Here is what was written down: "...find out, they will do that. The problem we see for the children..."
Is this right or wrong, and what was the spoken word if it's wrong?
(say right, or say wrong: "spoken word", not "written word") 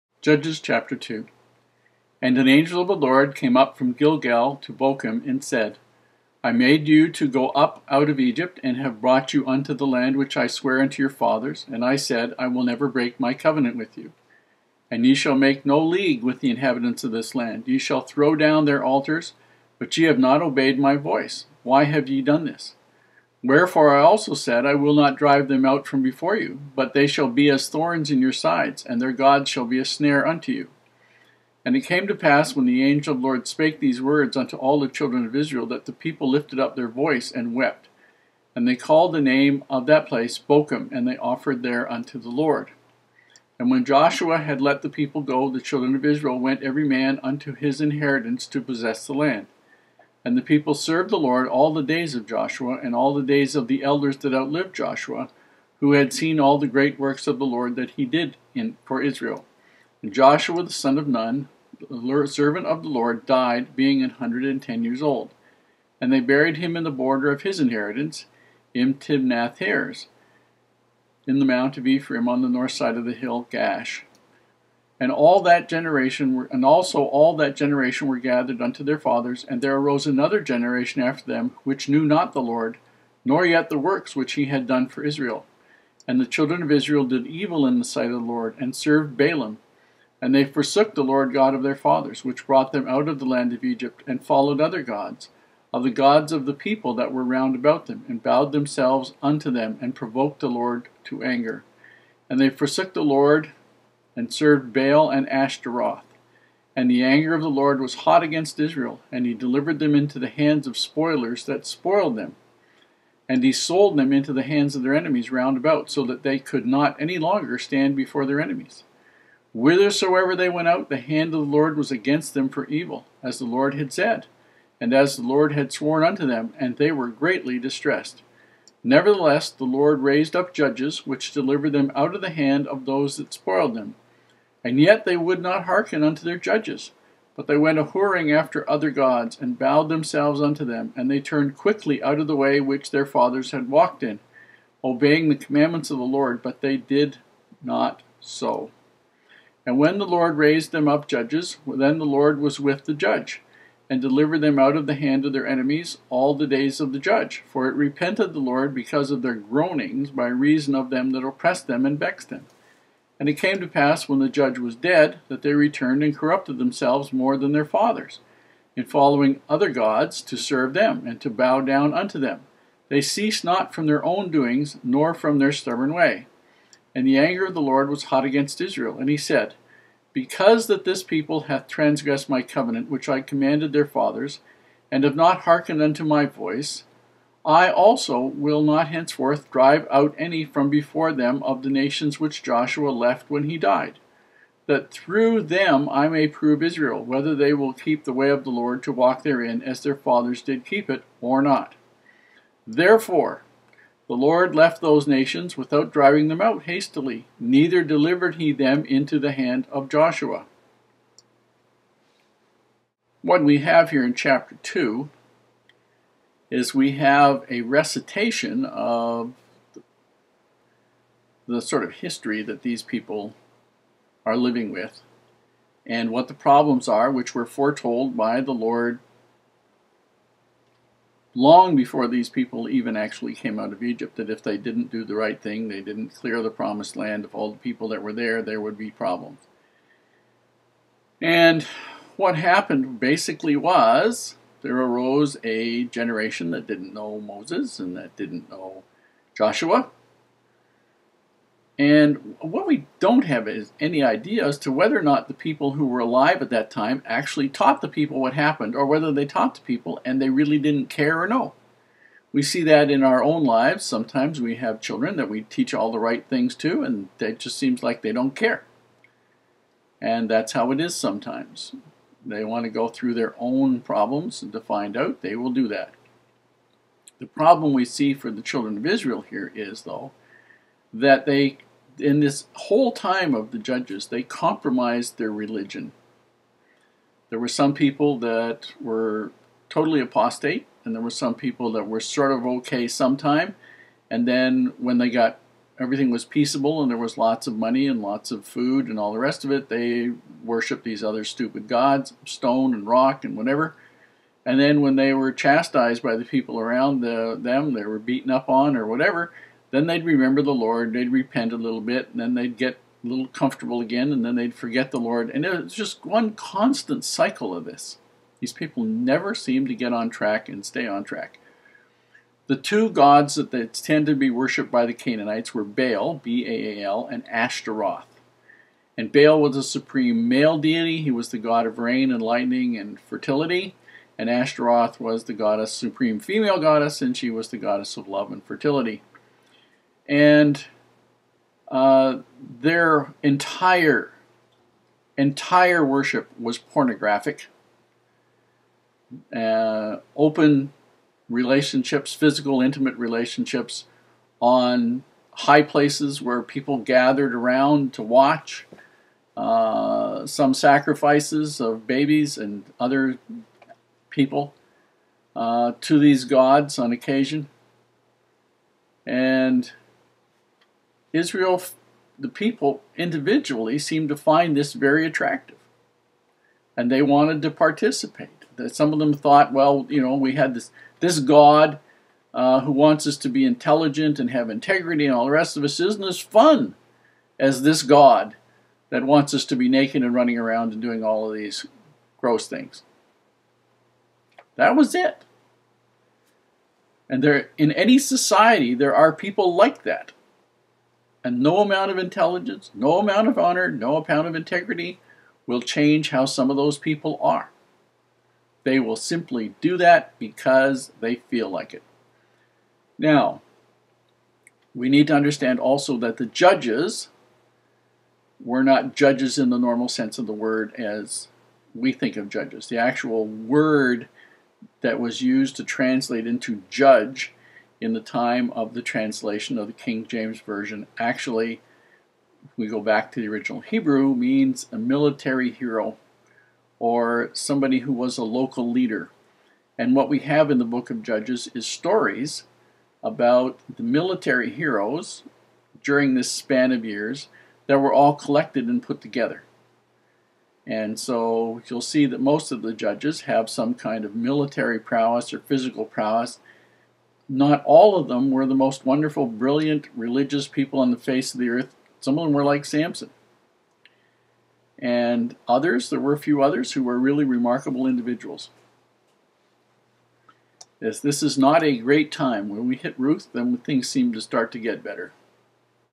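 right.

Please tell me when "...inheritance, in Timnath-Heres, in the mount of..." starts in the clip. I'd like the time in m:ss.
1:07.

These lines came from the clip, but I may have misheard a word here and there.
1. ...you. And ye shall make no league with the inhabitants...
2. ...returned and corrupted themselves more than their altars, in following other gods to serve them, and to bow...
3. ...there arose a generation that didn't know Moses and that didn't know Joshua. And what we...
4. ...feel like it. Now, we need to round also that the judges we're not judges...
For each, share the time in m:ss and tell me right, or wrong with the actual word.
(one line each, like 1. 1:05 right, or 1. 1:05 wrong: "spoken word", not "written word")
1. 0:13 right
2. 2:45 wrong: "fathers", not "altars"
3. 4:04 right
4. 6:51 wrong: "understand", not "round".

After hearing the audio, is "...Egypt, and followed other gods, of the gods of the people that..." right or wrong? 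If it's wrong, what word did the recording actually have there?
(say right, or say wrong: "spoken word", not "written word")
right.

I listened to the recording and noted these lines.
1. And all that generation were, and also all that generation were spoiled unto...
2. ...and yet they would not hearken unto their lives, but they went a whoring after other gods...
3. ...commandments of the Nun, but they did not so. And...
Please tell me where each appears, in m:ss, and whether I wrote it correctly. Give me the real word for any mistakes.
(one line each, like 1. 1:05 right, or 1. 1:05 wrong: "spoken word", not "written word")
1. 1:15 wrong: "gathered", not "spoiled"
2. 2:14 wrong: "judges", not "lives"
3. 2:25 wrong: "Lord", not "Nun".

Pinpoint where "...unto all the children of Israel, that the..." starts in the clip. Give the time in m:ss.
0:34.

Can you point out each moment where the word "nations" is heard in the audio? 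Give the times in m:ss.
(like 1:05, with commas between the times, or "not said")
3:11, 3:25.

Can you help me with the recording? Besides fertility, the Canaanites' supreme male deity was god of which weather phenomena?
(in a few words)
rain and lightning.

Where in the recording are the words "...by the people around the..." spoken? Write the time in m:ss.
5:06.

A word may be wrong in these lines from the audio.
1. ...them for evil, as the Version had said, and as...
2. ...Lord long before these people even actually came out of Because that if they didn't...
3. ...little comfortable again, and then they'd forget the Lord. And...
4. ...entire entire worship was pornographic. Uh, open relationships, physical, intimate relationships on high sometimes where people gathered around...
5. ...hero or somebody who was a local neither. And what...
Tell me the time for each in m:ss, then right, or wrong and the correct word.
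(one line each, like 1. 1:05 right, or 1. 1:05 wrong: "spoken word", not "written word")
1. 2:02 wrong: "Lord", not "Version"
2. 3:48 wrong: "Egypt", not "Because"
3. 5:13 right
4. 5:43 wrong: "places", not "sometimes"
5. 7:15 wrong: "leader", not "neither".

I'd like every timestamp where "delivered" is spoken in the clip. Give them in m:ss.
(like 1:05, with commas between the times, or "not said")
1:49, 2:11, 2:34, 3:27.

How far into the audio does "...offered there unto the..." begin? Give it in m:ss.
0:41.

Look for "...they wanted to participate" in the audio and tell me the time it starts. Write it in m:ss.
6:16.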